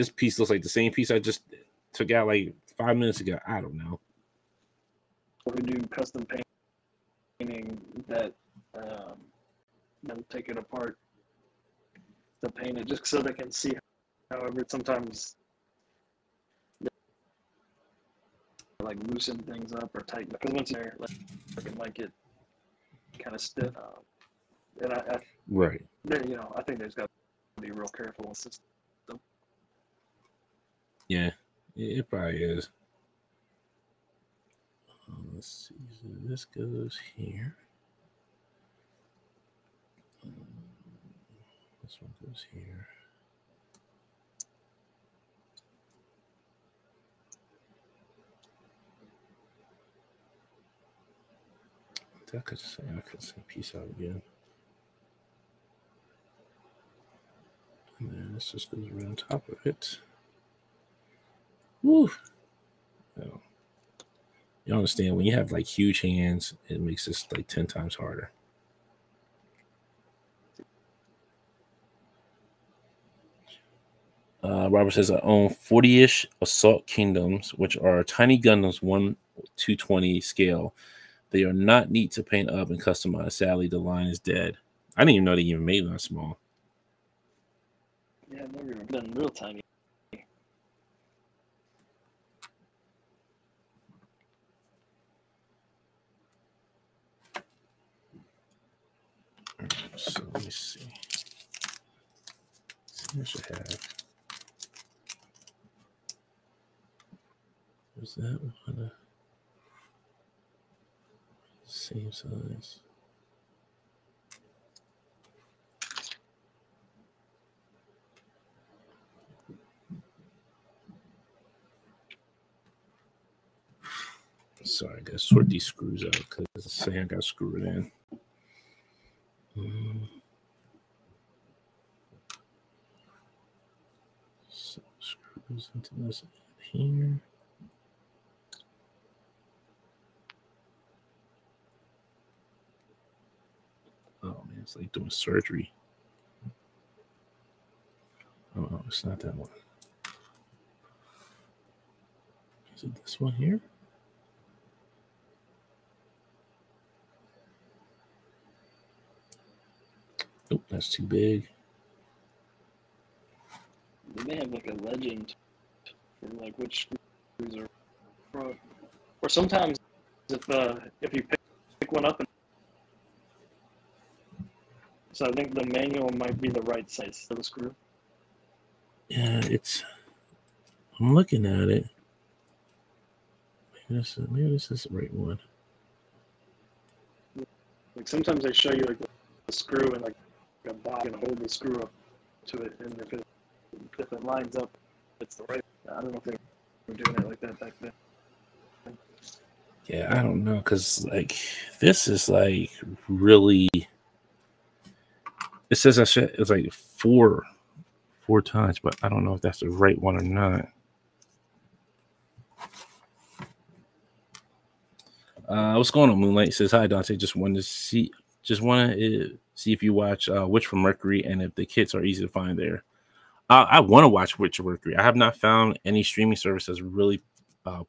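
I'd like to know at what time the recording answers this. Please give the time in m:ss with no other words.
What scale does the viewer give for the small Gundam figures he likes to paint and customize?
1:18.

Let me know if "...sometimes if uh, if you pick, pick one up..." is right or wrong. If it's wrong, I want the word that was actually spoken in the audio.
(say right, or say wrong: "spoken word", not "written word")
right.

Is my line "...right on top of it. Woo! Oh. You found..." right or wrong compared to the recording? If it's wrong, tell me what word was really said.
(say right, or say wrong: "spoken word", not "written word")
wrong: "understand", not "found".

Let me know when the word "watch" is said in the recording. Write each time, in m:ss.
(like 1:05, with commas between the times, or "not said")
3:39, 3:44.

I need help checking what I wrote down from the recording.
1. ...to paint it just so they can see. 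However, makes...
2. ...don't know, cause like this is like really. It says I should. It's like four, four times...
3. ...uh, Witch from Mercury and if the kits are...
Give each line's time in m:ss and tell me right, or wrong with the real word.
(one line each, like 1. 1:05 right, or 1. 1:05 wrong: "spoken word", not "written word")
1. 0:12 wrong: "sometimes", not "makes"
2. 3:20 right
3. 3:40 right.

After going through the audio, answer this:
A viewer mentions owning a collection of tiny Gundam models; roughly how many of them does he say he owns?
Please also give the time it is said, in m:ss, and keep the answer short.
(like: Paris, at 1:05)
40, at 1:15.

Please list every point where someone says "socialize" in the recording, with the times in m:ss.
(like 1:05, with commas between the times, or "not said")
not said.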